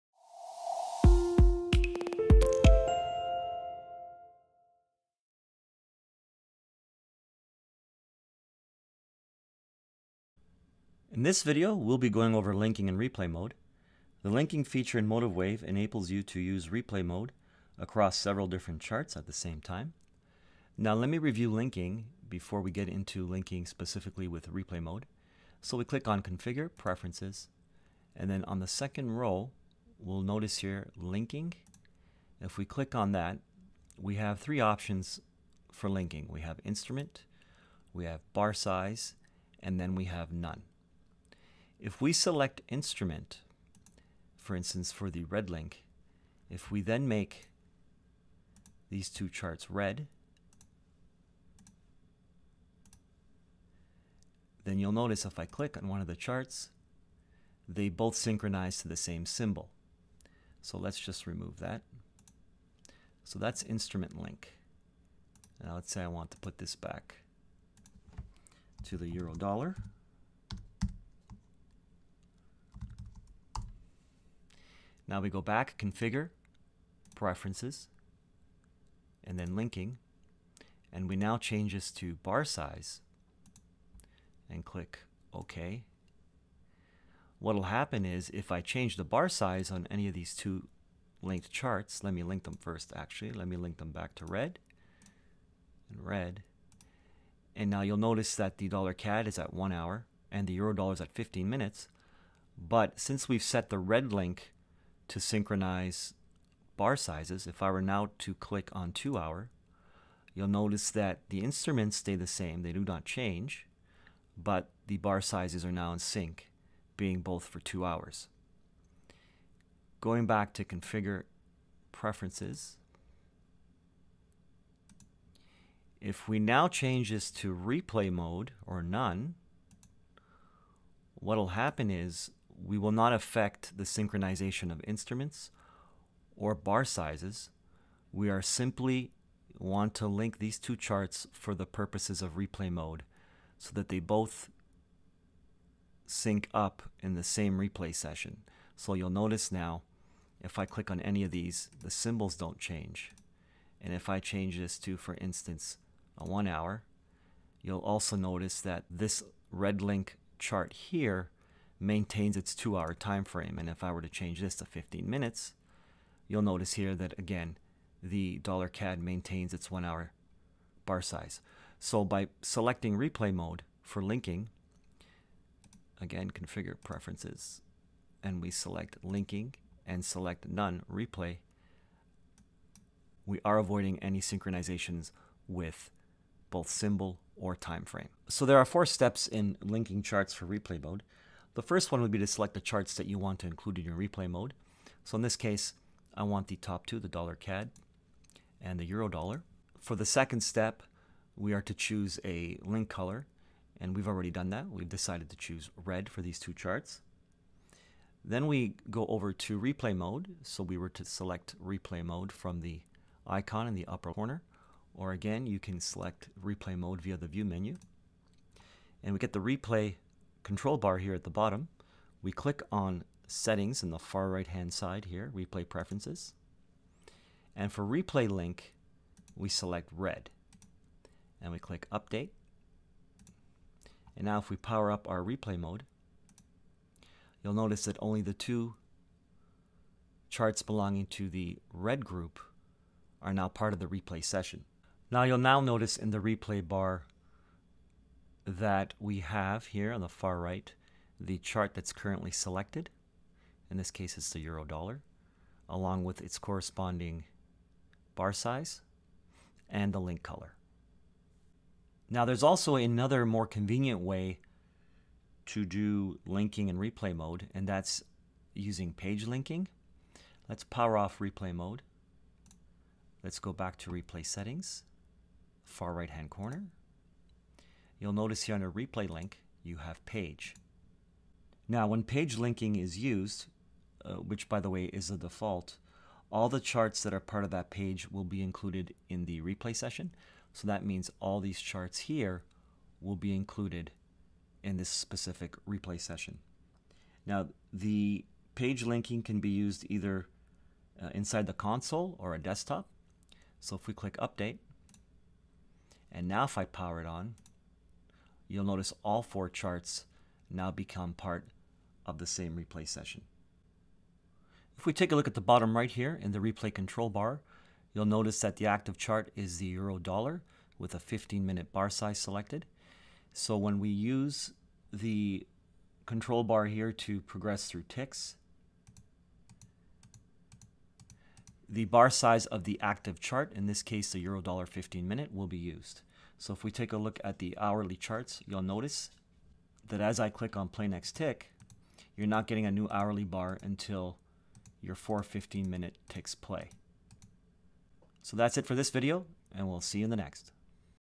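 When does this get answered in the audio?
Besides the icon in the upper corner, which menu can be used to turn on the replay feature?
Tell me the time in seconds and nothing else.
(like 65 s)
217 s.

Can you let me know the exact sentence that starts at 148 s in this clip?
So you'll notice now if I click on any of these, the symbols don't change.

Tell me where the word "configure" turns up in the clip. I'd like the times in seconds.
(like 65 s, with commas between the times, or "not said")
26 s, 75 s, 120 s, 176 s.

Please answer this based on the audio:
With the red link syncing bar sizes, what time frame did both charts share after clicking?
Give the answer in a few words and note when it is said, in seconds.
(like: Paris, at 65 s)
2 hour, at 108 s.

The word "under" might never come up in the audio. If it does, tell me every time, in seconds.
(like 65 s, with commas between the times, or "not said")
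278 s.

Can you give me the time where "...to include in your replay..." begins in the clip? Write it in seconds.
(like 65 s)
193 s.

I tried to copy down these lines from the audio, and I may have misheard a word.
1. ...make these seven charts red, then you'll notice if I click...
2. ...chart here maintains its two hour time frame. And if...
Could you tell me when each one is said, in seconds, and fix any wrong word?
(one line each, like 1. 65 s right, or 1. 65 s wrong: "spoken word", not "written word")
1. 47 s wrong: "two", not "seven"
2. 160 s right.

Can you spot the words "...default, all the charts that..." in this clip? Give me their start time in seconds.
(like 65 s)
285 s.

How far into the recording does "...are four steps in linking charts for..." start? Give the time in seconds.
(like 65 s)
188 s.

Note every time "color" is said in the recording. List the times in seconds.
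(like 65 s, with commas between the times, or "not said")
202 s, 260 s.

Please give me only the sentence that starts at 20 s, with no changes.
Now let me review linking before we get into linking specifically with replay mode.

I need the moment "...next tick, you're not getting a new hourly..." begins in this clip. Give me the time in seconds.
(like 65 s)
340 s.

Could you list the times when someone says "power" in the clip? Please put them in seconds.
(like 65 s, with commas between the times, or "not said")
234 s, 270 s, 306 s.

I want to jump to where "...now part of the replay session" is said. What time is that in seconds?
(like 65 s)
243 s.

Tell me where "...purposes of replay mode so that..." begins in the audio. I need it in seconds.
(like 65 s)
141 s.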